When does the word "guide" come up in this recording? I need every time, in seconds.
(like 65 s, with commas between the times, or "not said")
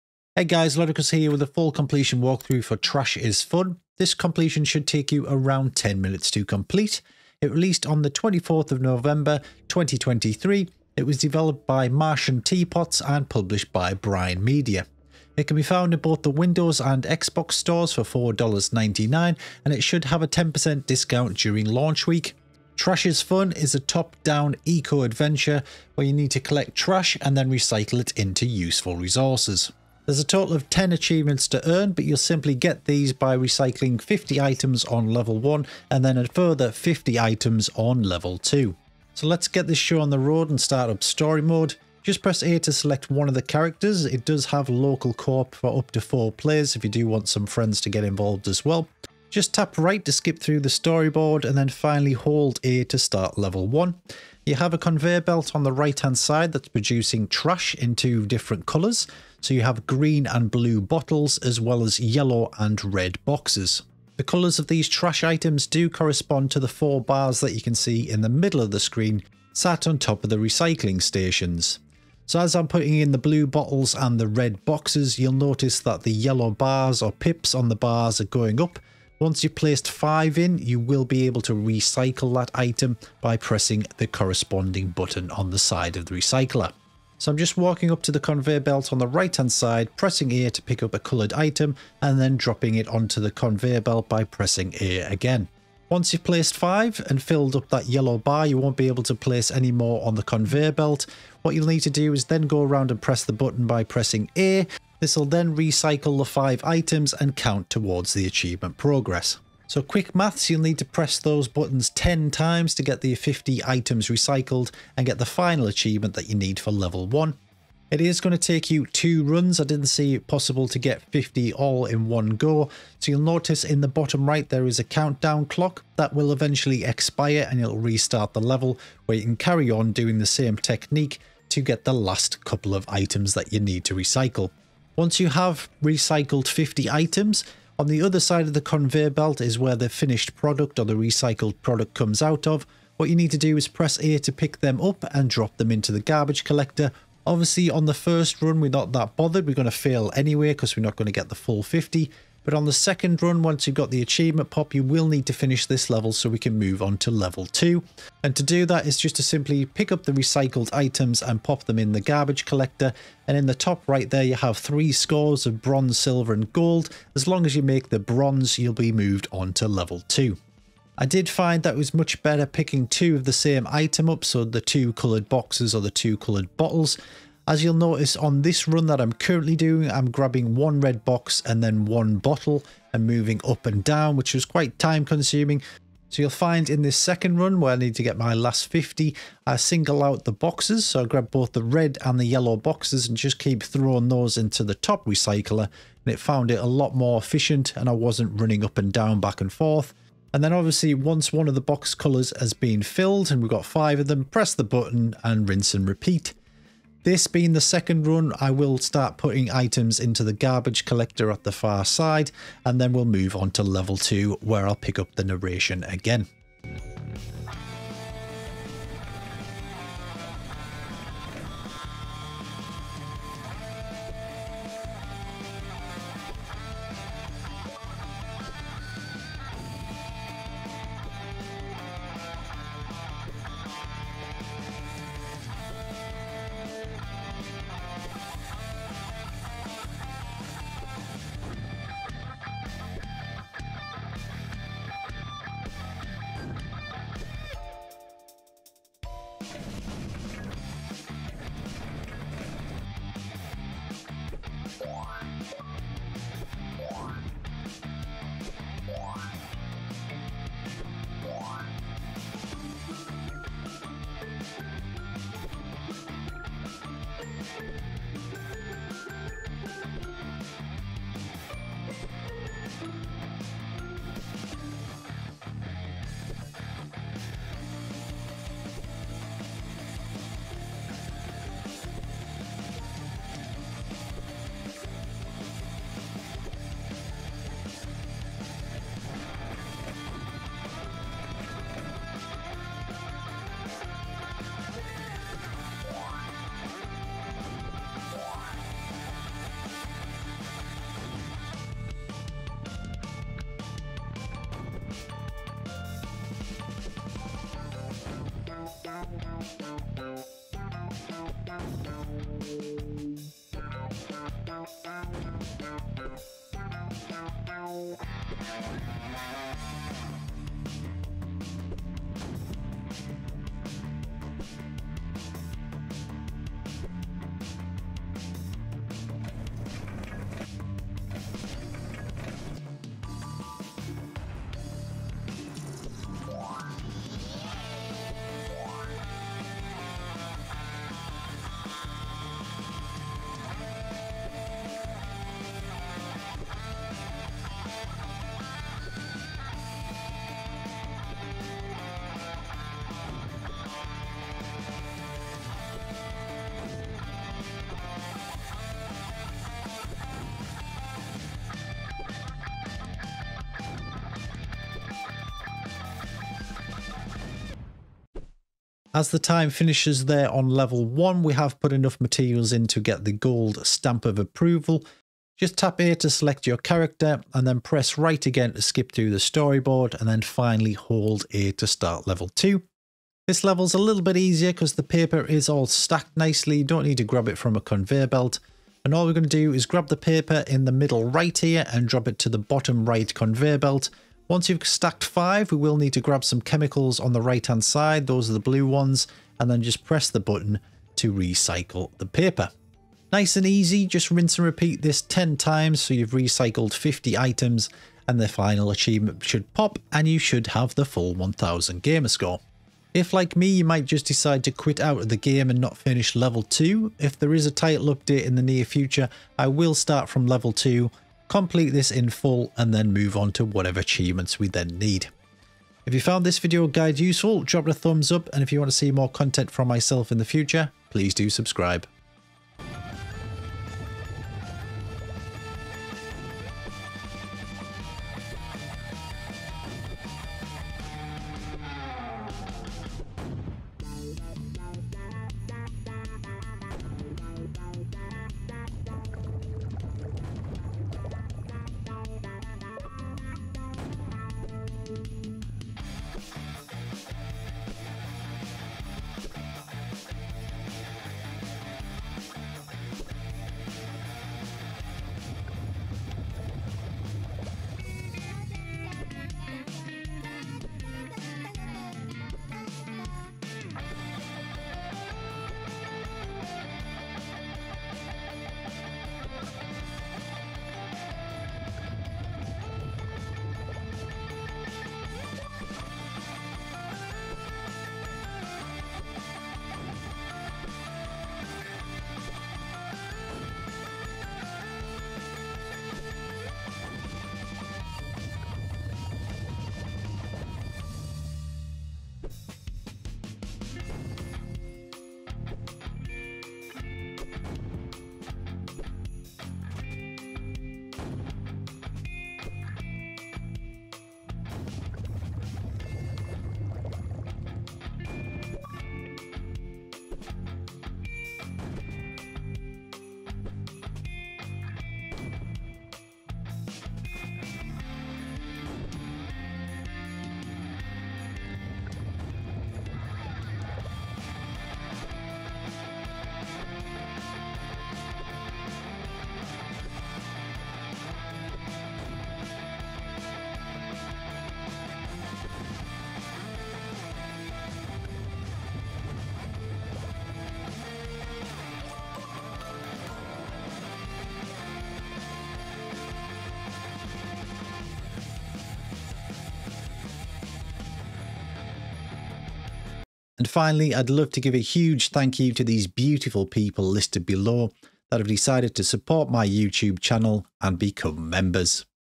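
426 s.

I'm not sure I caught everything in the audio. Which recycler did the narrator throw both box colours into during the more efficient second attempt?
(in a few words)
top recycler.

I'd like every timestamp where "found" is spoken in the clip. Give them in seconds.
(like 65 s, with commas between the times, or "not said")
15 s, 196 s, 426 s.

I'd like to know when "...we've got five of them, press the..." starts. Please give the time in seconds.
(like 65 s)
203 s.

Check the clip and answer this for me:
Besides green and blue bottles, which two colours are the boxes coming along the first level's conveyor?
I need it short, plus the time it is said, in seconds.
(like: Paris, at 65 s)
yellow and red, at 61 s.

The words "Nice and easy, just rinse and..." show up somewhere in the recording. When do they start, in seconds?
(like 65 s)
403 s.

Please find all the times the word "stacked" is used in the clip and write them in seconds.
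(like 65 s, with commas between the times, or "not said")
385 s, 394 s.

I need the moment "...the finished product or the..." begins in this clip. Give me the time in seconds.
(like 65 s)
139 s.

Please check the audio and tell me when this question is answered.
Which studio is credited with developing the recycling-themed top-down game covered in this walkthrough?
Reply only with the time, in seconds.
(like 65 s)
11 s.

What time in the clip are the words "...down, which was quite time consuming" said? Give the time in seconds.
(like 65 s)
183 s.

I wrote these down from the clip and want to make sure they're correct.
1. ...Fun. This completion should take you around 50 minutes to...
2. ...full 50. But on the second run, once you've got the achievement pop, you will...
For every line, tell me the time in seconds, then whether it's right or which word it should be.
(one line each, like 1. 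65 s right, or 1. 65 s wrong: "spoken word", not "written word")
1. 3 s wrong: "10", not "50"
2. 151 s right.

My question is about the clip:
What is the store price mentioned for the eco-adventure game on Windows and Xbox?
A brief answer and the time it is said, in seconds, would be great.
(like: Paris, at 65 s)
$4.99, at 18 s.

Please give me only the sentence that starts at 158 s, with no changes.
And to do that is just to simply pick up the recycled items and pop them in the garbage collector.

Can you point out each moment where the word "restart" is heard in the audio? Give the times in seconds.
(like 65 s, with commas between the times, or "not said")
127 s.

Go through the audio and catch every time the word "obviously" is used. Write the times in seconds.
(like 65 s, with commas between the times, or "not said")
147 s, 200 s.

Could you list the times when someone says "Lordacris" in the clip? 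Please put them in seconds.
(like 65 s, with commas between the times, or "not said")
0 s.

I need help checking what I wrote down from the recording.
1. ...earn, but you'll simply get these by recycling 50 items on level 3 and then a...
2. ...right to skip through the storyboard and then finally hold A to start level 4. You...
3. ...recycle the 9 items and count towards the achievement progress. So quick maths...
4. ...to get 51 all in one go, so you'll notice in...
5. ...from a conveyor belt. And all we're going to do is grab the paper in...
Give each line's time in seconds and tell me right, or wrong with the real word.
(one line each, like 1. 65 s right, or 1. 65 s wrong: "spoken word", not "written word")
1. 31 s wrong: "1", not "3"
2. 49 s wrong: "1", not "4"
3. 105 s wrong: "5", not "9"
4. 120 s wrong: "50", not "51"
5. 387 s right.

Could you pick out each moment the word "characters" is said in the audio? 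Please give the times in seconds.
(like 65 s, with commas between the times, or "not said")
43 s, 376 s.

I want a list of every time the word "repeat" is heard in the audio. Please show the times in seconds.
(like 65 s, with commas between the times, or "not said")
205 s, 404 s.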